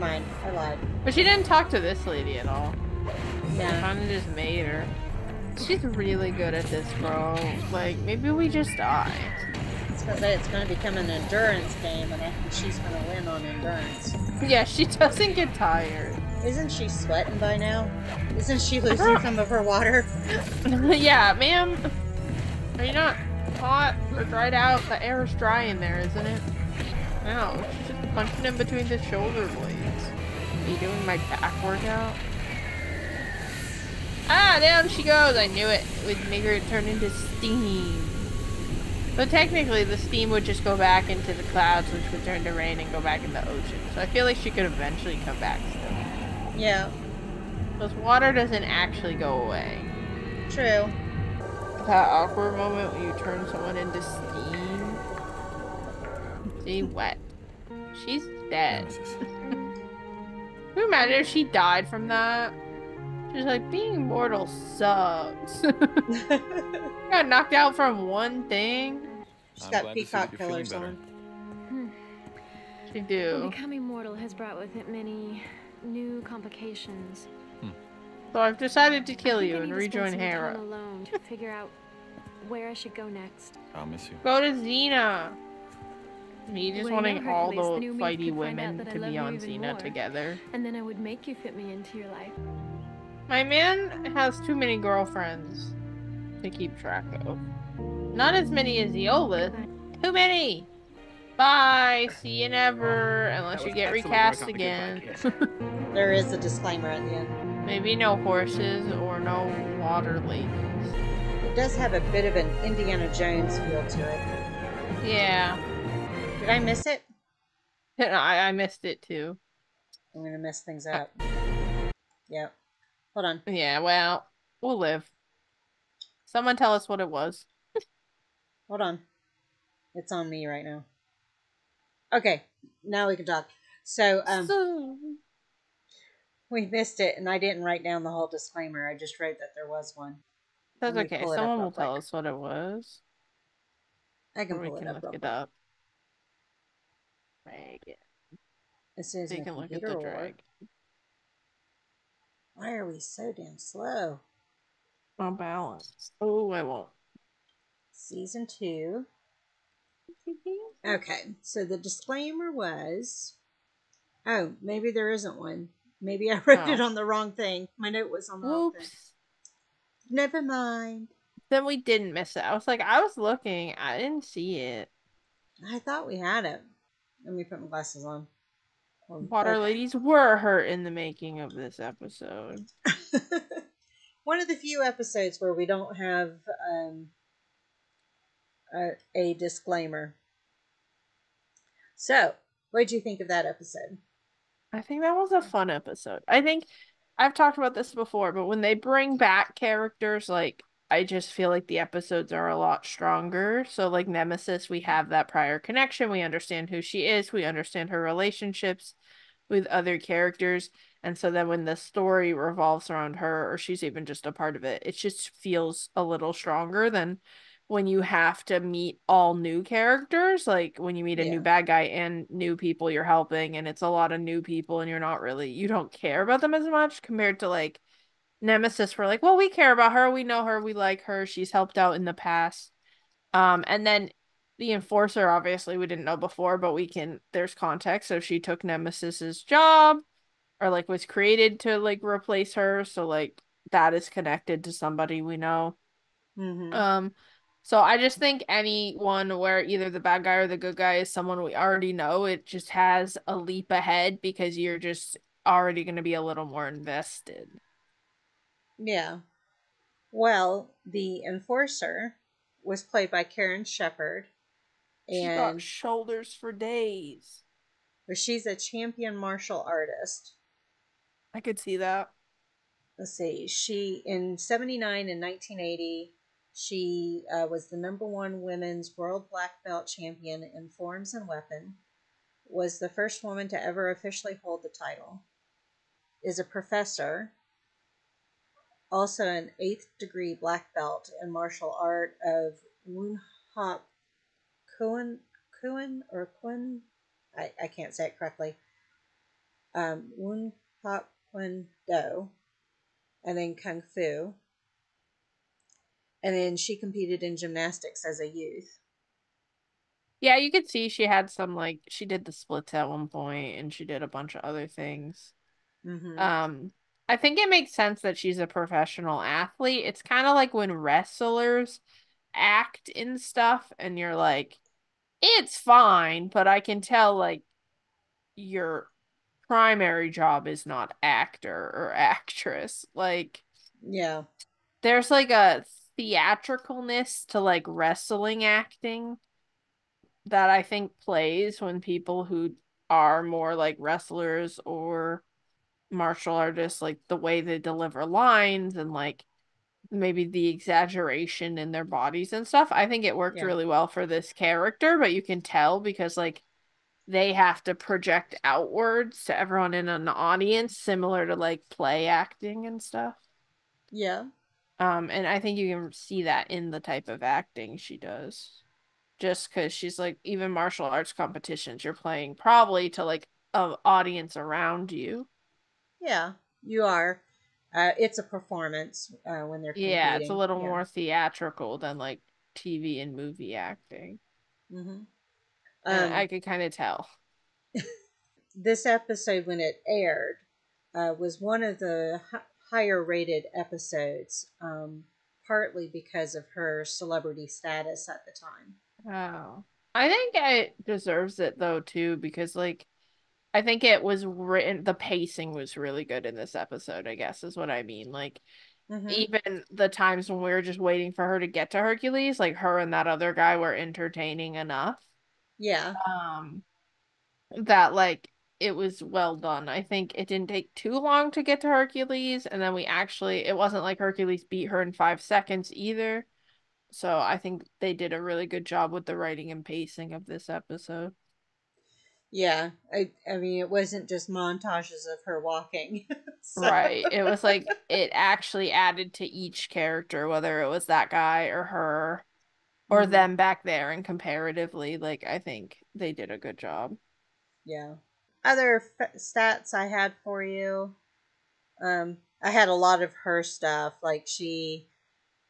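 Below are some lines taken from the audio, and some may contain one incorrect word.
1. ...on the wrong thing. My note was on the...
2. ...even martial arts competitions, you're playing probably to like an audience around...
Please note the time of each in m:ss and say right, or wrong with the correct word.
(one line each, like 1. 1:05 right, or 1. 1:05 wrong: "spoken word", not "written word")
1. 2:46 right
2. 6:10 right.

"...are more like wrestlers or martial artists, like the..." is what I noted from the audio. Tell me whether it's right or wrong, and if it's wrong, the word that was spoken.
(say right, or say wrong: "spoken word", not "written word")
right.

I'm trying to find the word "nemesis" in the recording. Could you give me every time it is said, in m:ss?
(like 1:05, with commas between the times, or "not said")
3:24, 3:48, 3:58.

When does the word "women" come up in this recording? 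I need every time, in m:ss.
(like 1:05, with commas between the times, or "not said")
1:28, 4:38.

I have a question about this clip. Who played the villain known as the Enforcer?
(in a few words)
Karen Sheperd.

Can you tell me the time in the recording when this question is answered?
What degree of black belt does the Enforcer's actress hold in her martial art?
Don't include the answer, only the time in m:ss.
4:49.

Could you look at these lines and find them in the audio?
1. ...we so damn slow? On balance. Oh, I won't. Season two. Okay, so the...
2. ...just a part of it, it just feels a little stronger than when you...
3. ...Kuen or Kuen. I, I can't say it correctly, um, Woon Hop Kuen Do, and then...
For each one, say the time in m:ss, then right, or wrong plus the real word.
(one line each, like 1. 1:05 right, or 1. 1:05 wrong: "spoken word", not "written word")
1. 2:32 right
2. 3:34 right
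3. 4:55 right.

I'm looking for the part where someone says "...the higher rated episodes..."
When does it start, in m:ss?
6:31.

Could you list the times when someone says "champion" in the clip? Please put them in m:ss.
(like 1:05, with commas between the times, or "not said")
4:28, 4:39.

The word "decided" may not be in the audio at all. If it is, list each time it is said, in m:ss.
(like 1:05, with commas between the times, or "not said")
1:18.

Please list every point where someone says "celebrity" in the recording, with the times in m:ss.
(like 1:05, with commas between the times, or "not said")
6:36.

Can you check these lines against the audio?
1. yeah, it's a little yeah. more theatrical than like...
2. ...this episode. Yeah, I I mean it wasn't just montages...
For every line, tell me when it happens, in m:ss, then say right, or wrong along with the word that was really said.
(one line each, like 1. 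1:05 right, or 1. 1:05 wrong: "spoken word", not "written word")
1. 6:19 right
2. 7:10 right.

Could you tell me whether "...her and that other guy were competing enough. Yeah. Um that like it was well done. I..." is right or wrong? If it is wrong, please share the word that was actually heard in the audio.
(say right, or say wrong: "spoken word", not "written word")
wrong: "entertaining", not "competing".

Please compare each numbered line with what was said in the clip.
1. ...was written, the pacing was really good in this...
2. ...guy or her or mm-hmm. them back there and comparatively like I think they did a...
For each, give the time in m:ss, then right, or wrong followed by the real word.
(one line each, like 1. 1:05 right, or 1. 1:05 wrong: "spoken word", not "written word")
1. 6:44 right
2. 7:21 right.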